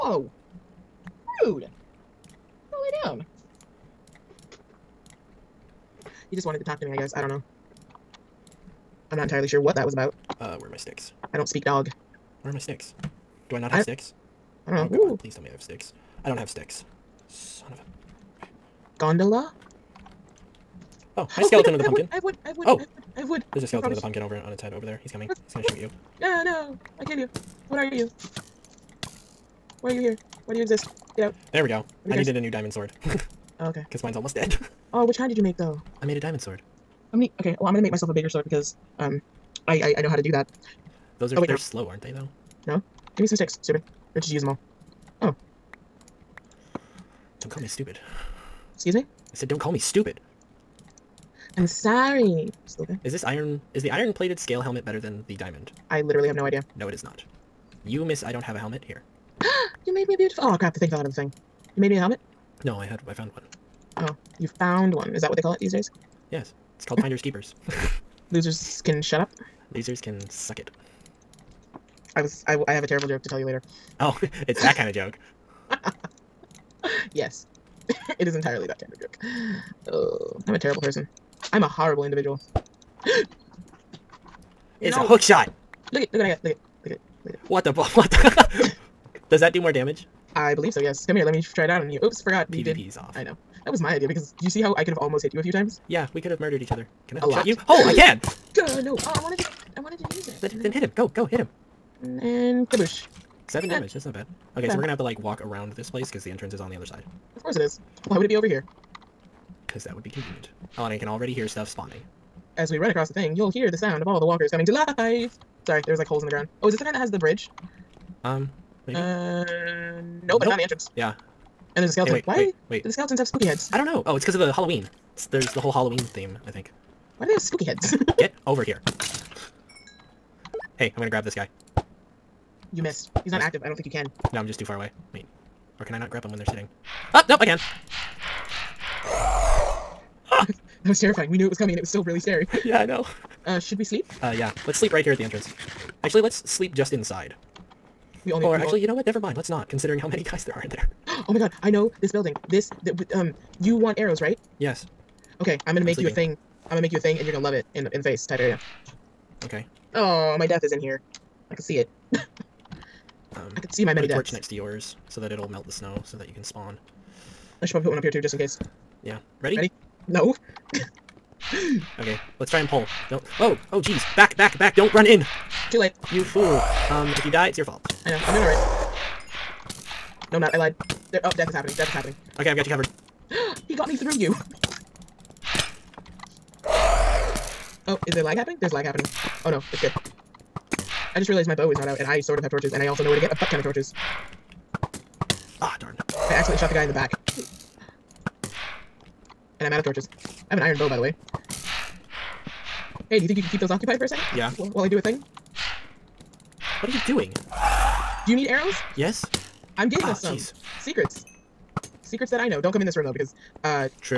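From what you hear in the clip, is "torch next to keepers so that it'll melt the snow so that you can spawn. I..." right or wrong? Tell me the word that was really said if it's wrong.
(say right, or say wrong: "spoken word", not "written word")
wrong: "yours", not "keepers".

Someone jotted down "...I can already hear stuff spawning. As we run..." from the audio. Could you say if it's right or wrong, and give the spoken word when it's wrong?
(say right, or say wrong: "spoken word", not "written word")
right.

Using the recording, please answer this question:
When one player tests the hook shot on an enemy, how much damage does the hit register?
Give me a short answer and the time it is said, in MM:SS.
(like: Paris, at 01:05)
7, at 01:43.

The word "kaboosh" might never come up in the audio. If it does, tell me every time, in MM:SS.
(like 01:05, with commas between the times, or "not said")
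01:42.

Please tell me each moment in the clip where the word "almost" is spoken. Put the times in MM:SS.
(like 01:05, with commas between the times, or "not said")
00:34, 01:34.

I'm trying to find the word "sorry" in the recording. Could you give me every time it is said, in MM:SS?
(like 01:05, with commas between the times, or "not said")
00:51, 01:55.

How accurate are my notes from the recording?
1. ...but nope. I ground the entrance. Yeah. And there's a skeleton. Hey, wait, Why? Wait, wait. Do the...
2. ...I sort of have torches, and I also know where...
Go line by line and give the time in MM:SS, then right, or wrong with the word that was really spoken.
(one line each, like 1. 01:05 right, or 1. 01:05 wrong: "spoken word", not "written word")
1. 02:00 wrong: "found", not "ground"
2. 03:12 right.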